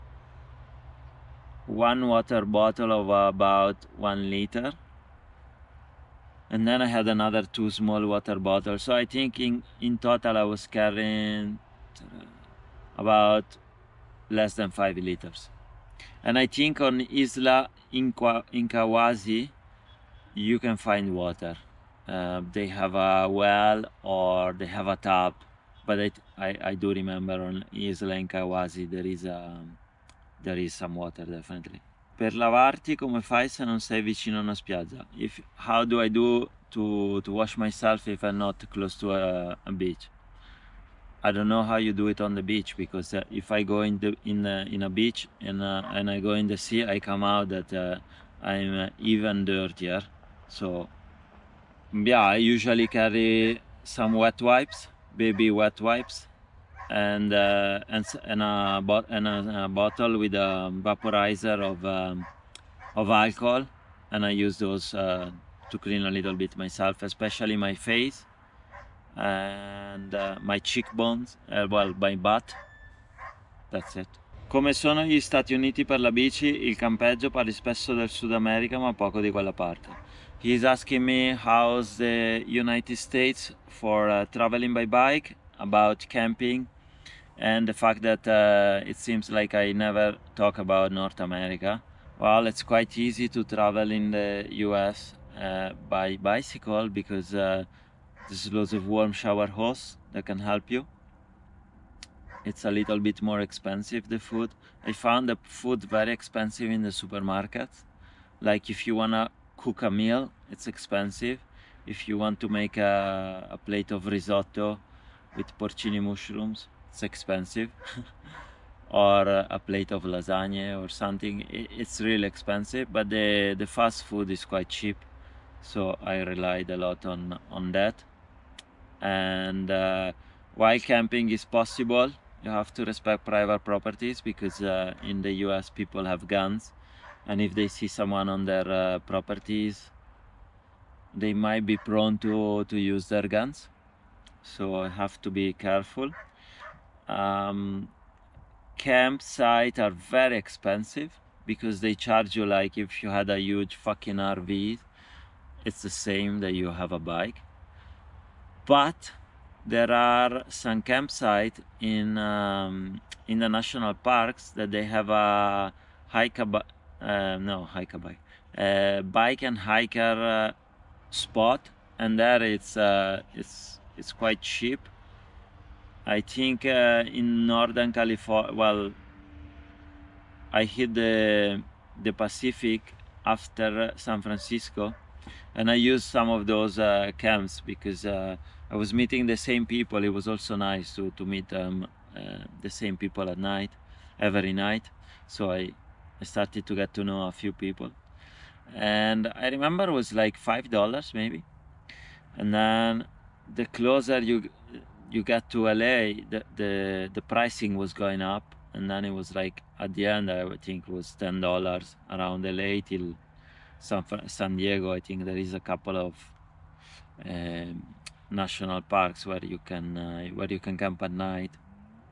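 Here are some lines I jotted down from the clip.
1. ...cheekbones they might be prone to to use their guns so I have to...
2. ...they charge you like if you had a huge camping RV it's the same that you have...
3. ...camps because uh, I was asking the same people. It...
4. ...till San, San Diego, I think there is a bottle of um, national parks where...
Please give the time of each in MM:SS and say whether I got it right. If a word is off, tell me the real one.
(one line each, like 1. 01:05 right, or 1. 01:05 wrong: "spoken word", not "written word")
1. 02:19 wrong: "properties", not "cheekbones"
2. 02:31 wrong: "fucking", not "camping"
3. 03:07 wrong: "meeting", not "asking"
4. 03:32 wrong: "couple", not "bottle".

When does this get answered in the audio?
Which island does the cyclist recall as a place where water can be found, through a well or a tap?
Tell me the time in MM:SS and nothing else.
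00:27.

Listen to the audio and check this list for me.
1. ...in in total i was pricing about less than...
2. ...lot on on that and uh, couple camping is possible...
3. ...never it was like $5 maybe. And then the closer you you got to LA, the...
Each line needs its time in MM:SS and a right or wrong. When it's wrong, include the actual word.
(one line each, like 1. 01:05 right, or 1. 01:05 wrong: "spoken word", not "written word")
1. 00:09 wrong: "carrying", not "pricing"
2. 02:06 wrong: "while", not "couple"
3. 03:19 wrong: "remember", not "never".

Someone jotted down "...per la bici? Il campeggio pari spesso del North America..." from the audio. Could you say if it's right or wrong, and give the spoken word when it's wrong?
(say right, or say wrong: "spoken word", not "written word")
wrong: "Sud", not "North".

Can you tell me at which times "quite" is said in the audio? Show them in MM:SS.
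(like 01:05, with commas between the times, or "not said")
01:32, 02:04, 02:54.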